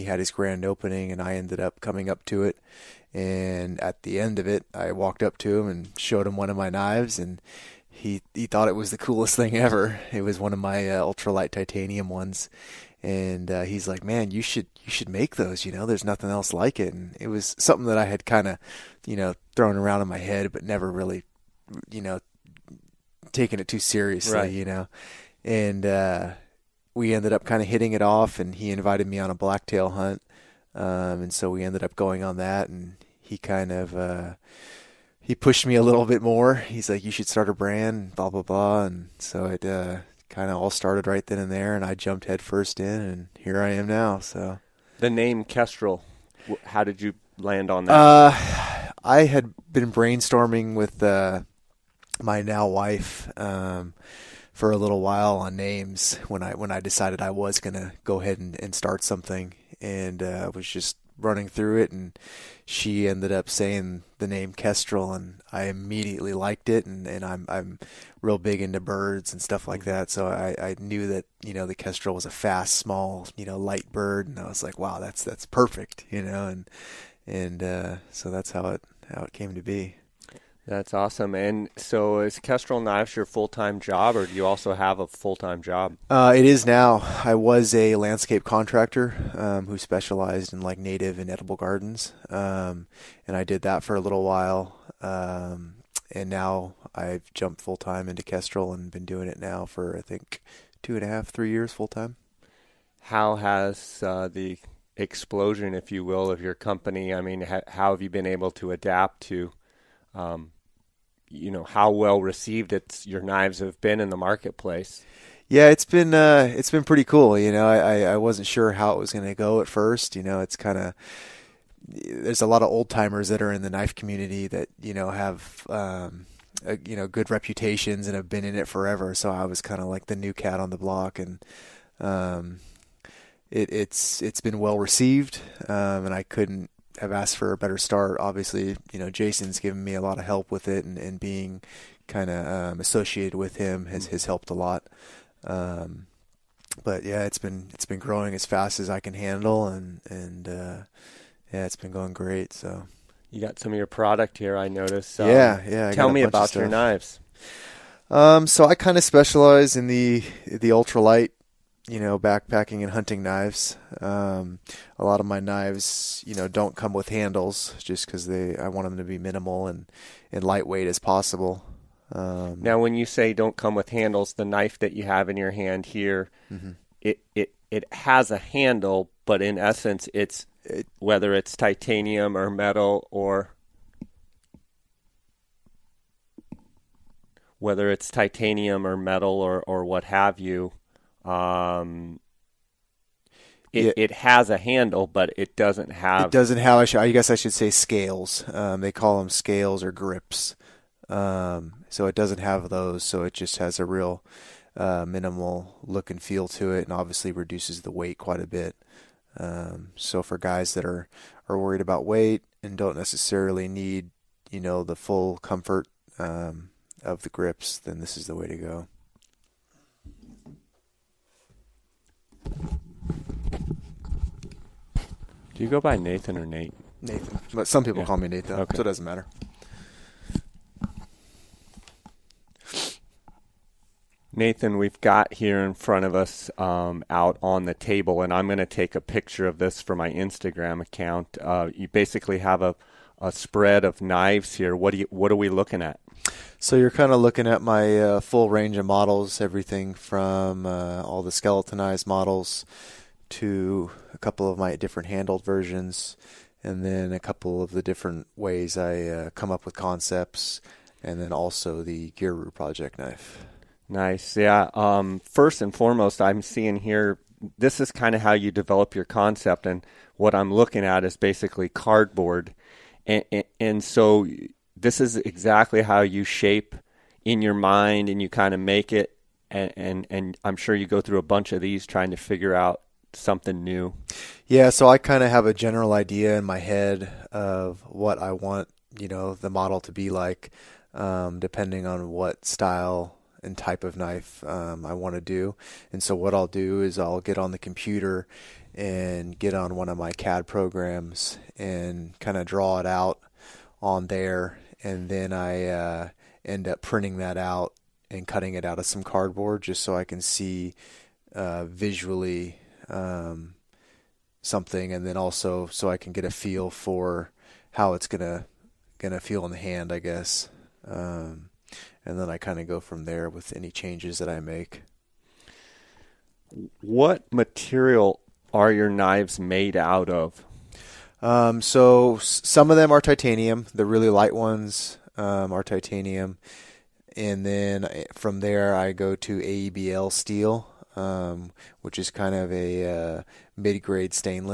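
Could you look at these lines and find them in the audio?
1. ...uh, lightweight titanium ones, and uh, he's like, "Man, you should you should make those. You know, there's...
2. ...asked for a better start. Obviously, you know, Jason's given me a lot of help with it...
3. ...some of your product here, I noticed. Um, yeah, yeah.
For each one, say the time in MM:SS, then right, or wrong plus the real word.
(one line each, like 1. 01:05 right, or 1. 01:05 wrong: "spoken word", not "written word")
1. 00:10 wrong: "ultralight", not "lightweight"
2. 02:17 right
3. 02:33 right.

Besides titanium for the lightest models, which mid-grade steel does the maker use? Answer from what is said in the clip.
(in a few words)
AEBL steel.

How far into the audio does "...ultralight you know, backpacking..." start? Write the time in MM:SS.
02:40.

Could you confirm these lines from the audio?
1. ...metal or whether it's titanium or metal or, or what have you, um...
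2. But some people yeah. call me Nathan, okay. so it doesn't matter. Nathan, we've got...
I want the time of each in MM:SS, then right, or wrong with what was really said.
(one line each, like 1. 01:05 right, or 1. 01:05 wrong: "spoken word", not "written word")
1. 03:02 right
2. 03:47 right.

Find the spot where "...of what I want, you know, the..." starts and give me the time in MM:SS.
04:47.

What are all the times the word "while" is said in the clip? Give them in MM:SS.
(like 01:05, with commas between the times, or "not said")
00:54, 01:34.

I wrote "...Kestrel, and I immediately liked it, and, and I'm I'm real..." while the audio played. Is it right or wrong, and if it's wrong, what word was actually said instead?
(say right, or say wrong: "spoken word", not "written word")
right.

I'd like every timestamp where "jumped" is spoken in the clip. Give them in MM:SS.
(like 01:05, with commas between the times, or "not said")
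00:41, 01:37.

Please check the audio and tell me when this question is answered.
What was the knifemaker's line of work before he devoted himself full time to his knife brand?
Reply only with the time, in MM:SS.
01:27.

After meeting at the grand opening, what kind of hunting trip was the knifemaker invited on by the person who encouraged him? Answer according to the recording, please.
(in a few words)
Blacktail hunt.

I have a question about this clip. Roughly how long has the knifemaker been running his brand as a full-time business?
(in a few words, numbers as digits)
2.5 to 3 years.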